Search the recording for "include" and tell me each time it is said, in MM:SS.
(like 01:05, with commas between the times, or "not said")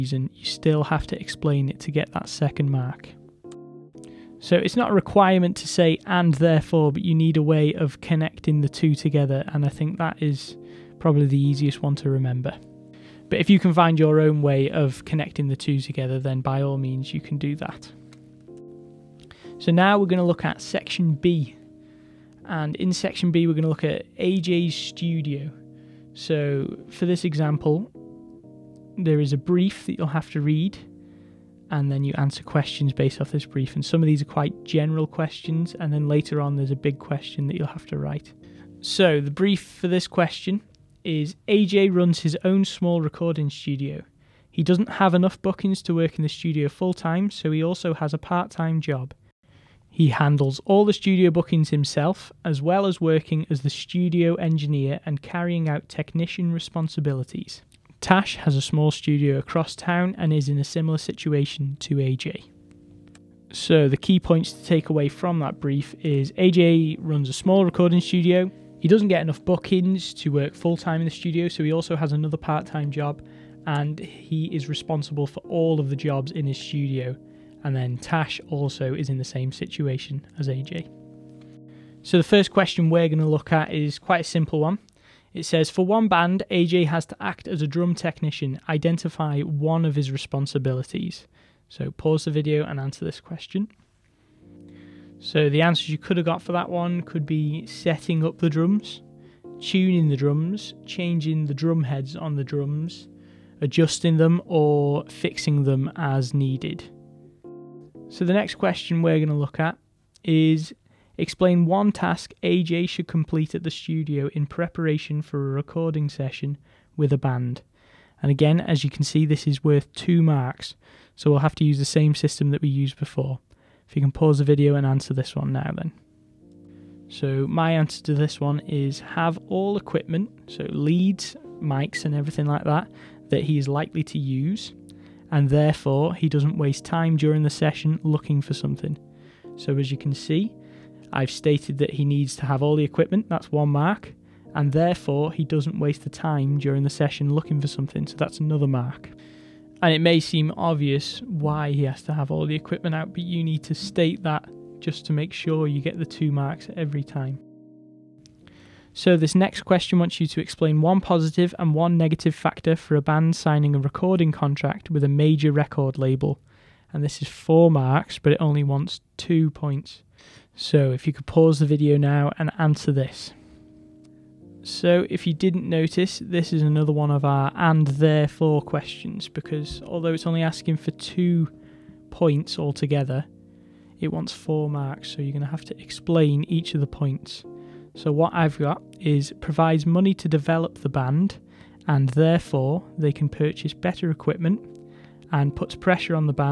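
not said.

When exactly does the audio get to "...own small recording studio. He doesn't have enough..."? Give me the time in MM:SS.
00:42.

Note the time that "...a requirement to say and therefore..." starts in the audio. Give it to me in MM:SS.
00:04.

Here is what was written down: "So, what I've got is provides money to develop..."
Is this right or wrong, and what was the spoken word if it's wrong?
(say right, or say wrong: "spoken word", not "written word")
right.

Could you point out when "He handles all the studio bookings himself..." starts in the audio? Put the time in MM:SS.
00:49.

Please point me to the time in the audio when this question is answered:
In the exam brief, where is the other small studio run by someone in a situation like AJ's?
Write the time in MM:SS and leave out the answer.
00:59.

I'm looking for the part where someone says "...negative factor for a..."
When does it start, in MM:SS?
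02:41.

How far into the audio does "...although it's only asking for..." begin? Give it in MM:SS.
02:59.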